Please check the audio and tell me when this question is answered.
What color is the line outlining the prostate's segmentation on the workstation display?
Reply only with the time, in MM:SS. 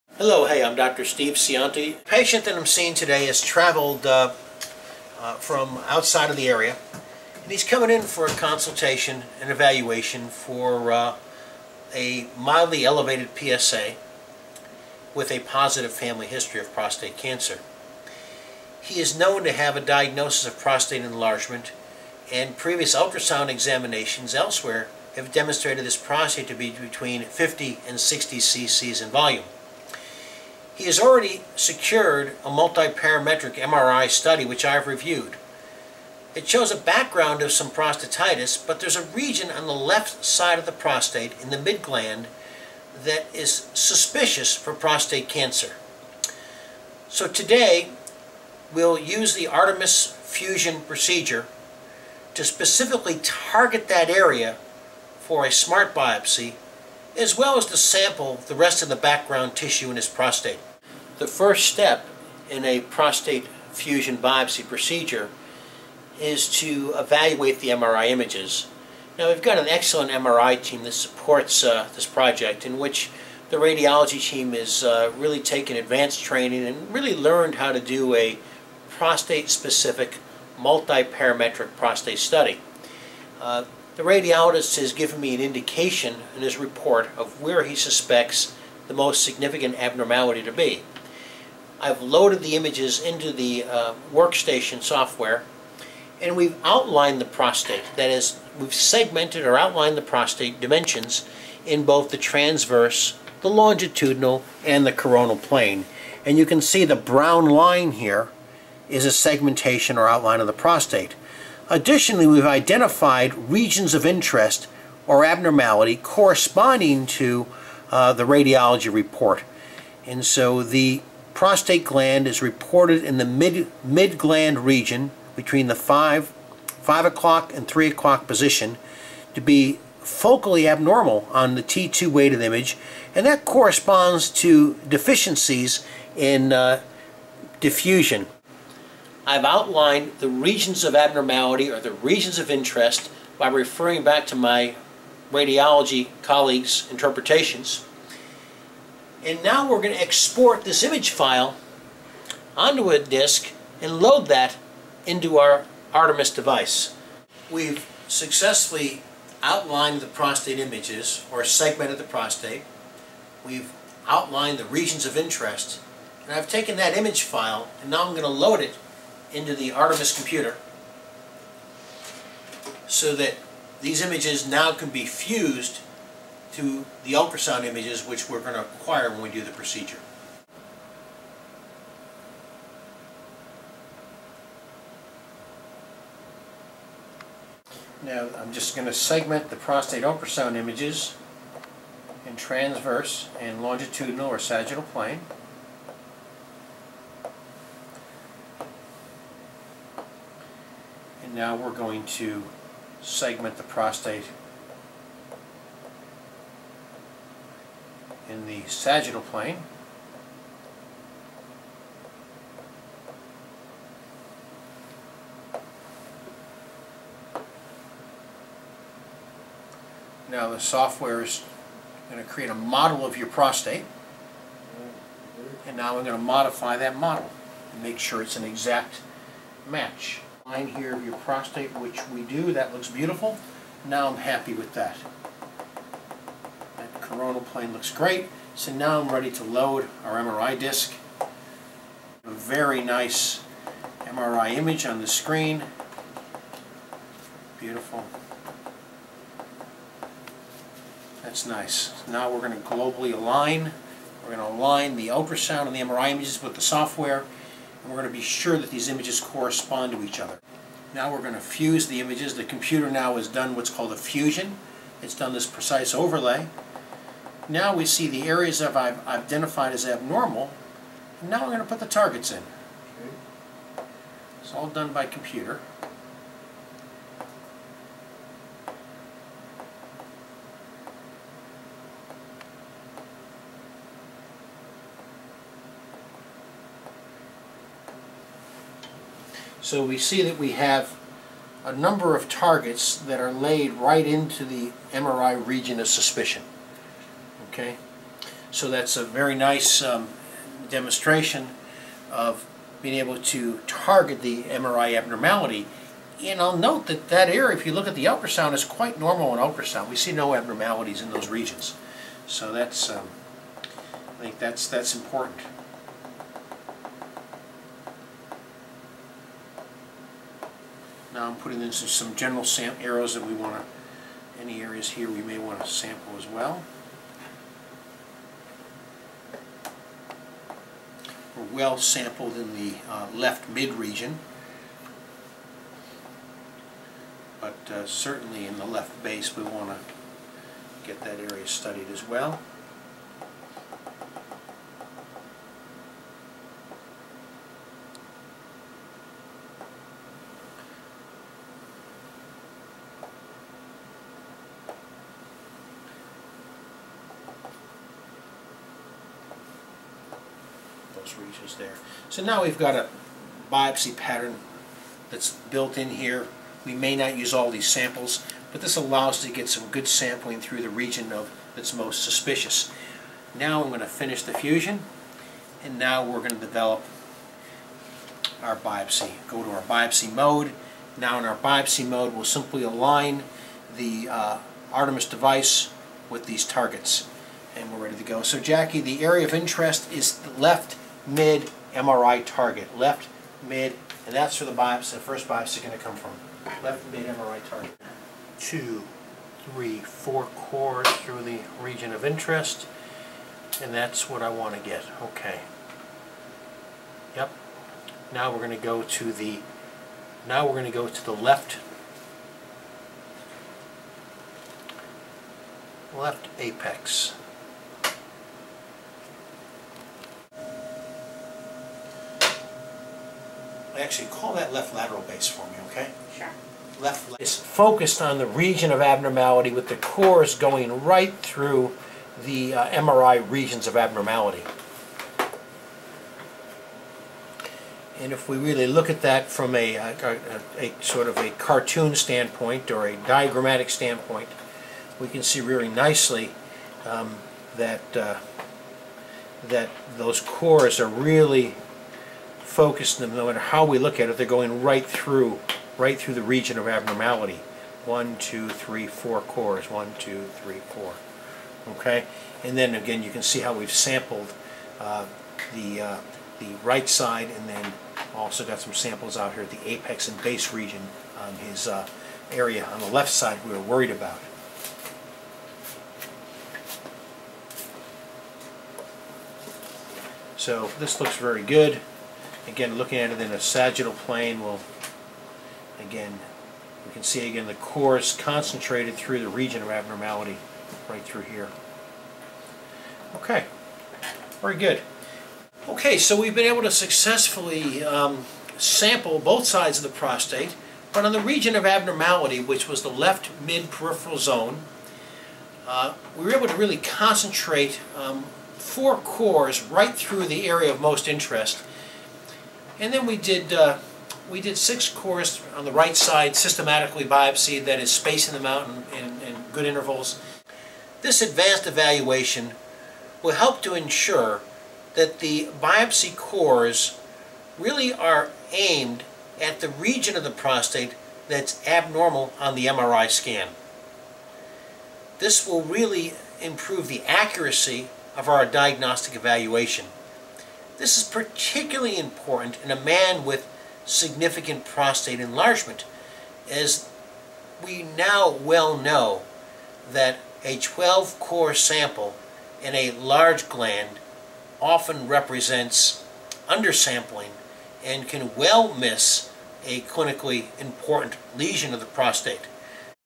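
01:46.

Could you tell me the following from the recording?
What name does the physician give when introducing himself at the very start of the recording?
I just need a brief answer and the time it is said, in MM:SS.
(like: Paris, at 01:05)
Steve Scionti, at 00:01.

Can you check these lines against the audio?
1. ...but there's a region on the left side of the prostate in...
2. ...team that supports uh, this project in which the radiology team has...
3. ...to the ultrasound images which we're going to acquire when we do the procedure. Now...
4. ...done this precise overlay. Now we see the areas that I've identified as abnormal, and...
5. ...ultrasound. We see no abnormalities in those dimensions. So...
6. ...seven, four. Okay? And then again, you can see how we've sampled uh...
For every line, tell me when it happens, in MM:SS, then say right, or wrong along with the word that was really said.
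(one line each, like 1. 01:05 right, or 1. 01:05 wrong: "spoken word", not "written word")
1. 00:38 right
2. 01:10 right
3. 02:56 right
4. 04:25 right
5. 05:09 wrong: "regions", not "dimensions"
6. 07:40 wrong: "three", not "seven".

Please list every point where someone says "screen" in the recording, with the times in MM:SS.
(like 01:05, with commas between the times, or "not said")
04:05.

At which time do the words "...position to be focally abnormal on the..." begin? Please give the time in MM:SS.
02:08.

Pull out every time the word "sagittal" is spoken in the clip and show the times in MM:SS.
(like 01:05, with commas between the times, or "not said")
03:14, 03:28, 08:03.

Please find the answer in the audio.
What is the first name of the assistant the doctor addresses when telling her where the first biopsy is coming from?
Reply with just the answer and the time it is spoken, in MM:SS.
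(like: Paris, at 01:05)
Jackie, at 06:28.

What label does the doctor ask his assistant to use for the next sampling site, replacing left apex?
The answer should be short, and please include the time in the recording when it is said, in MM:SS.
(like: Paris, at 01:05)
Left lateral base, at 07:04.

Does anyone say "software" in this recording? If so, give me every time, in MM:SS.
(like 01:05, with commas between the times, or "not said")
01:34, 03:40, 04:16.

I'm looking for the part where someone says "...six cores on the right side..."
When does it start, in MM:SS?
08:34.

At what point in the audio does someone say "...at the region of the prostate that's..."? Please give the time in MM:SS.
08:49.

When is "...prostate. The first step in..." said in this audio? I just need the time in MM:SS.
01:00.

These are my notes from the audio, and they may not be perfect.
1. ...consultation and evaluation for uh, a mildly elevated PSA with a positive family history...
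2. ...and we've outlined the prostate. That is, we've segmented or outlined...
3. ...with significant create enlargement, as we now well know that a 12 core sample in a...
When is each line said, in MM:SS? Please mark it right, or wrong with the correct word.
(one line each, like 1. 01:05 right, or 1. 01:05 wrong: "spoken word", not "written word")
1. 00:08 right
2. 01:36 right
3. 09:03 wrong: "prostate", not "create".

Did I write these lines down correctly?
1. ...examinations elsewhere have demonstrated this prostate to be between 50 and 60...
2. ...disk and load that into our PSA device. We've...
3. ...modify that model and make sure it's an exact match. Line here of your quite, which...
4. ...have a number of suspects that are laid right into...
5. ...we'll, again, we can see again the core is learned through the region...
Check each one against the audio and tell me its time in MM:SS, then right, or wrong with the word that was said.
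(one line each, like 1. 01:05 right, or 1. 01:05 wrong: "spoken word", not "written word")
1. 00:23 right
2. 02:32 wrong: "Artemis", not "PSA"
3. 03:46 wrong: "prostate", not "quite"
4. 04:50 wrong: "targets", not "suspects"
5. 08:04 wrong: "concentrated", not "learned".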